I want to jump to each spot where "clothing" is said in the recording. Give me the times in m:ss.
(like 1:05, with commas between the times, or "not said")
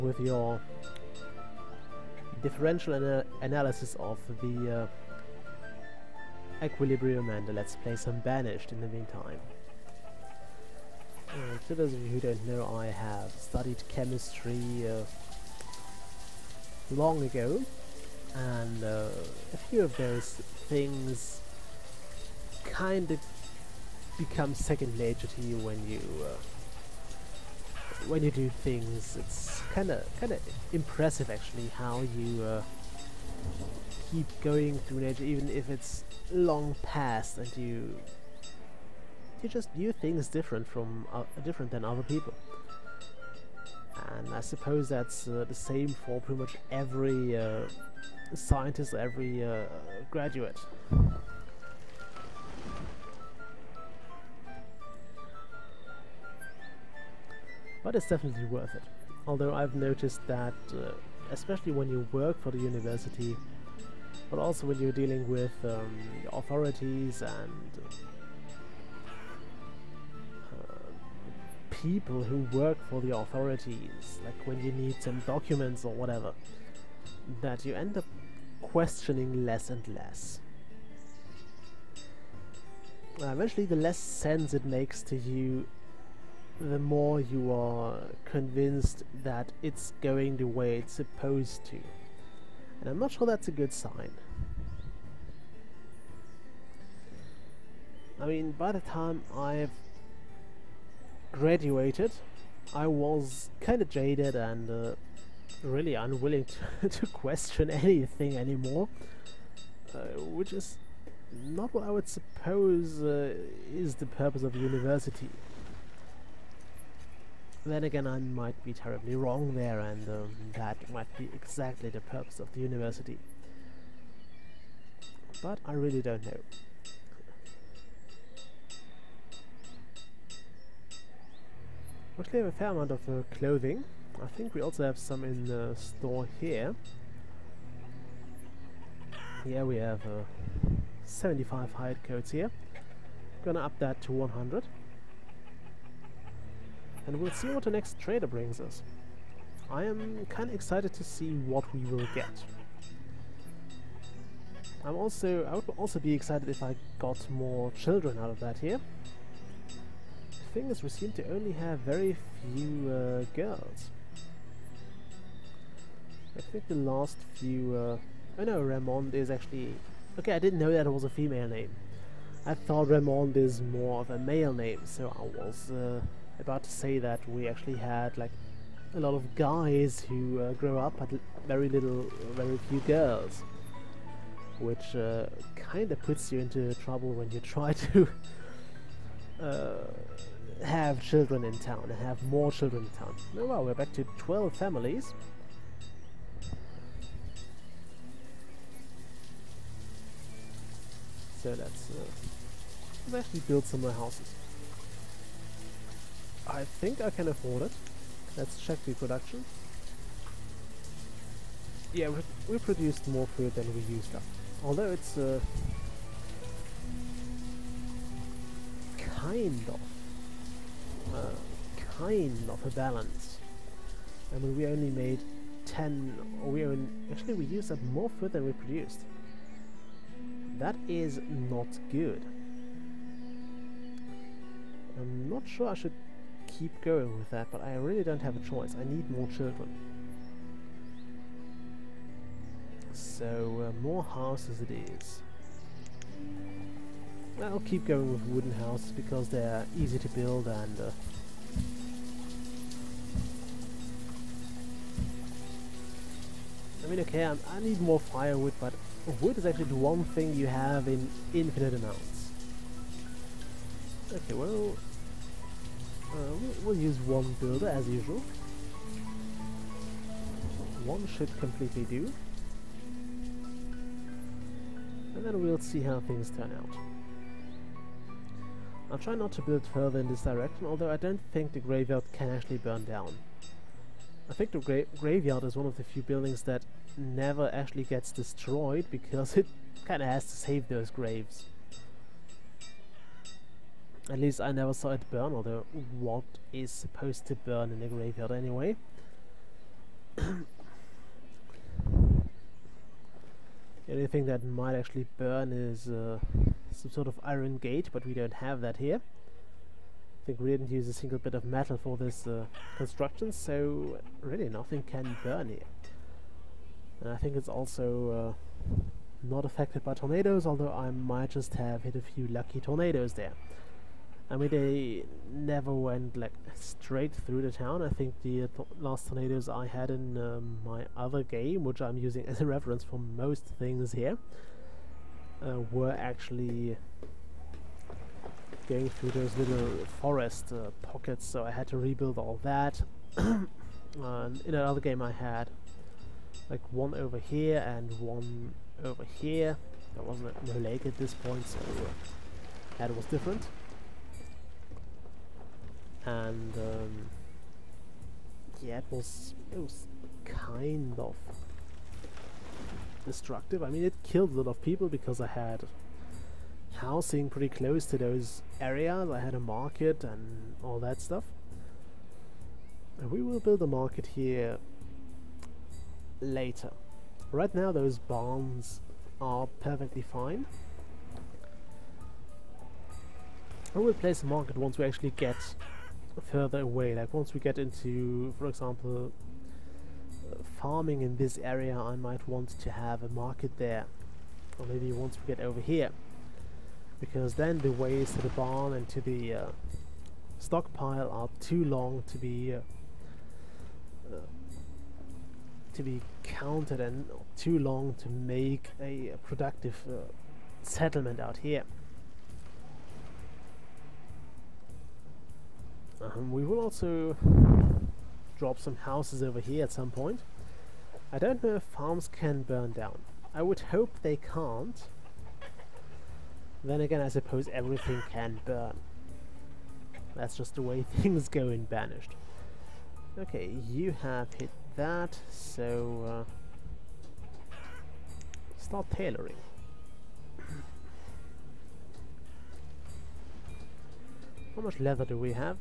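2:13.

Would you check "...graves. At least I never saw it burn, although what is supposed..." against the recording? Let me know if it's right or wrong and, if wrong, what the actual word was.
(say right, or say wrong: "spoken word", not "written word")
right.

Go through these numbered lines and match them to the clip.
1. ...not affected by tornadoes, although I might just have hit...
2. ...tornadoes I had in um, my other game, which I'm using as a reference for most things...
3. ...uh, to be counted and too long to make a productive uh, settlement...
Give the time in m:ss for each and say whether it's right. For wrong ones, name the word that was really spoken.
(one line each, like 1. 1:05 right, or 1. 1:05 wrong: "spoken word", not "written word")
1. 5:19 right
2. 5:29 right
3. 6:44 right.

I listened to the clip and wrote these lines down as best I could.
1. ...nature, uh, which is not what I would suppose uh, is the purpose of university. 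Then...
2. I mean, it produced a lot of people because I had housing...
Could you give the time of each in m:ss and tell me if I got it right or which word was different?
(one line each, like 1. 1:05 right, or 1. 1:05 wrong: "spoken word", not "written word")
1. 1:48 wrong: "anymore", not "nature"
2. 6:03 wrong: "killed", not "produced".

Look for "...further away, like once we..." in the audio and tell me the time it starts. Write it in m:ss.
6:26.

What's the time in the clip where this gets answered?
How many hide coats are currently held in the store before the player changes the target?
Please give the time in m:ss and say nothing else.
2:21.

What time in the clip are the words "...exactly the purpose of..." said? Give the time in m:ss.
2:01.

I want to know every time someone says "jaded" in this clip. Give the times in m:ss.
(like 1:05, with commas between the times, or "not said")
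1:43.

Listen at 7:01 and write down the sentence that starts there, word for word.
I don't know if farms can burn down.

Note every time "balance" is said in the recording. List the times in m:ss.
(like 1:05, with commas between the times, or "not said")
3:42.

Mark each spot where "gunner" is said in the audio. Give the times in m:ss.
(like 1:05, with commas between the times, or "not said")
not said.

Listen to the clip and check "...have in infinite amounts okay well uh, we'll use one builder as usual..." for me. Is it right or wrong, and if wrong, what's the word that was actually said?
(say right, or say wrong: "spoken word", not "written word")
right.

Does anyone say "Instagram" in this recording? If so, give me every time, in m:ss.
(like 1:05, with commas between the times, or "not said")
not said.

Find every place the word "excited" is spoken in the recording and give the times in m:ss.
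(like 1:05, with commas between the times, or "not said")
2:30, 2:36.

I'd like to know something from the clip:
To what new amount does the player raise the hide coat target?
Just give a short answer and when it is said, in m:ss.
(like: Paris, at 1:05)
100, at 2:24.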